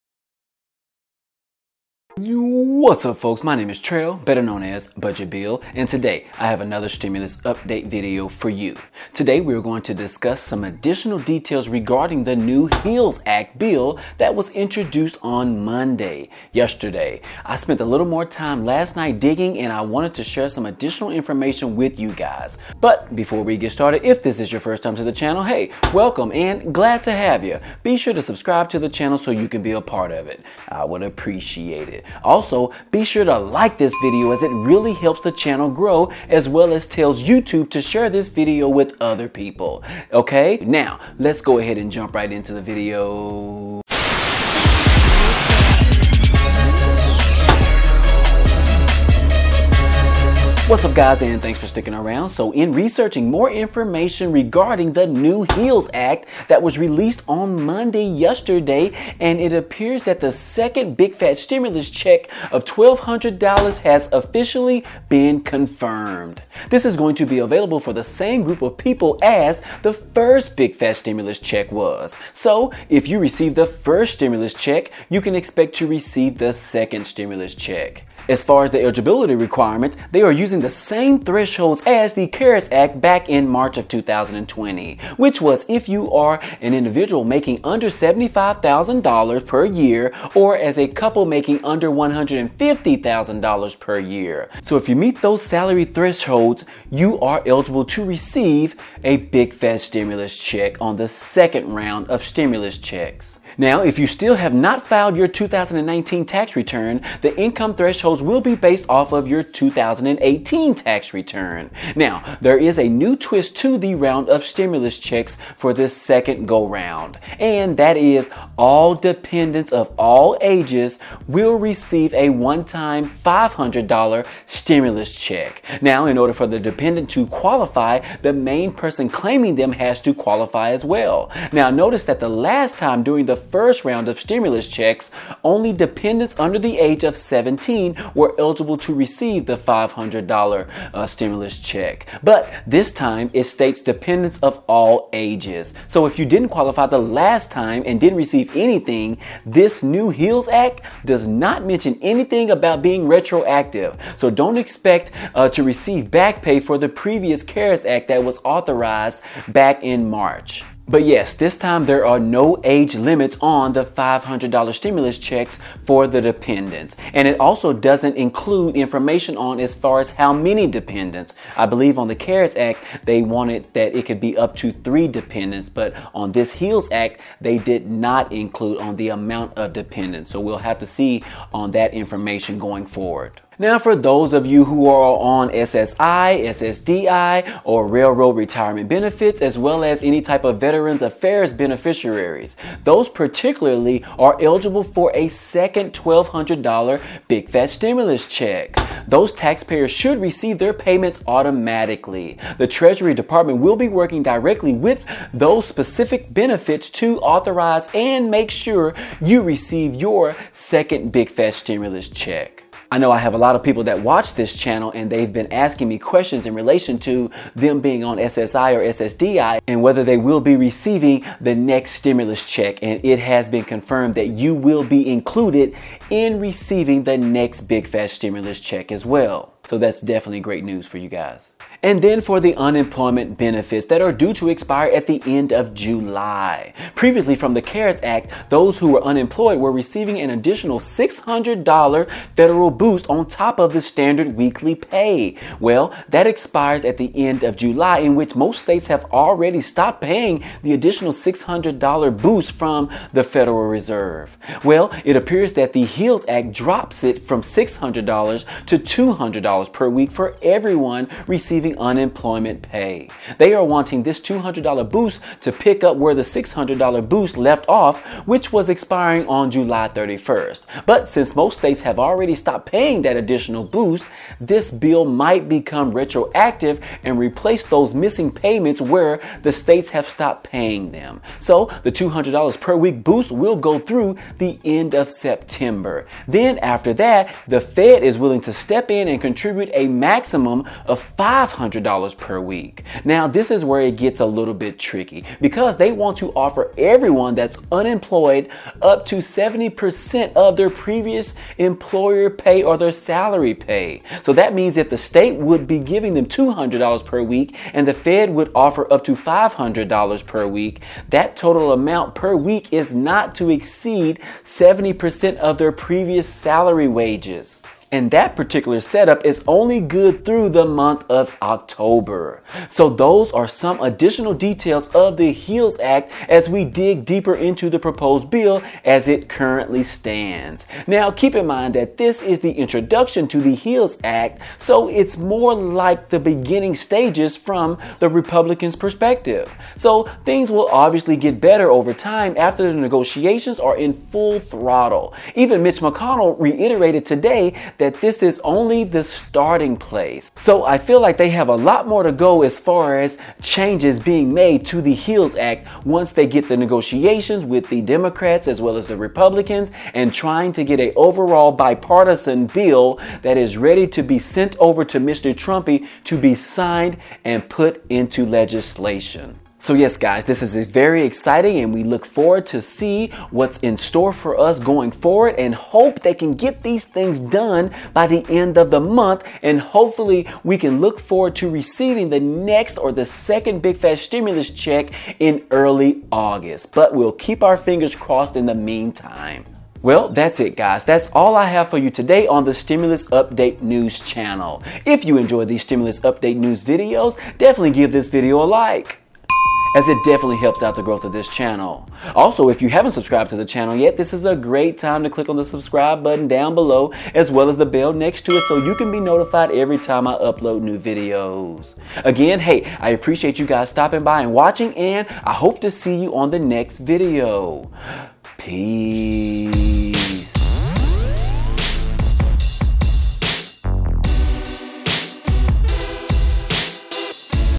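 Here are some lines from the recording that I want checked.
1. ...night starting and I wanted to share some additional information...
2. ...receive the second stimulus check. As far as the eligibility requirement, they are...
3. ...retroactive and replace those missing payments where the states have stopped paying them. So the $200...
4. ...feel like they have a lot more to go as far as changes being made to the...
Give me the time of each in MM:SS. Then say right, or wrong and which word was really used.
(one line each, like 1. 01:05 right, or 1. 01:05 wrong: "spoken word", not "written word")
1. 00:18 wrong: "digging", not "starting"
2. 01:15 right
3. 04:35 right
4. 05:50 right.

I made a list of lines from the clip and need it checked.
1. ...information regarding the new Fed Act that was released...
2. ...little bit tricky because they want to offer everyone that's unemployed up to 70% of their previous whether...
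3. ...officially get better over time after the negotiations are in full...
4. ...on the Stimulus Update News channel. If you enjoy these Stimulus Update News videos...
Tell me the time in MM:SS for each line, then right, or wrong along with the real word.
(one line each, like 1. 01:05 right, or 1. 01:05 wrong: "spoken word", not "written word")
1. 00:53 wrong: "HEALS", not "Fed"
2. 04:54 wrong: "employer", not "whether"
3. 05:40 wrong: "obviously", not "officially"
4. 06:32 right.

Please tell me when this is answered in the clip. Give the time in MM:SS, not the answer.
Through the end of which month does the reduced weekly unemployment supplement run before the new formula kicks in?
04:45.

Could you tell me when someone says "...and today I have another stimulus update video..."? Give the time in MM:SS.
00:05.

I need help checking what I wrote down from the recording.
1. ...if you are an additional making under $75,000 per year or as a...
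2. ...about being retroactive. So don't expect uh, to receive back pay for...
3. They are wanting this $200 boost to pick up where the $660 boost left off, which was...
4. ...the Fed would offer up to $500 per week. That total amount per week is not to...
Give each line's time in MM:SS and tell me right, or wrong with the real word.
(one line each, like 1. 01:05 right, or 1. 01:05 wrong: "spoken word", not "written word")
1. 01:25 wrong: "individual", not "additional"
2. 02:32 right
3. 04:23 wrong: "600", not "660"
4. 05:07 right.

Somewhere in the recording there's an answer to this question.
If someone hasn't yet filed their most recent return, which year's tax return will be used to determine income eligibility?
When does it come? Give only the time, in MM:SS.
01:49.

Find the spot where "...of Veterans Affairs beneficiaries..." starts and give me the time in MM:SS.
03:10.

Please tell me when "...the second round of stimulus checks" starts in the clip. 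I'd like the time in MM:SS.
01:40.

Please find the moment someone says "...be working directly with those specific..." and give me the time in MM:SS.
03:23.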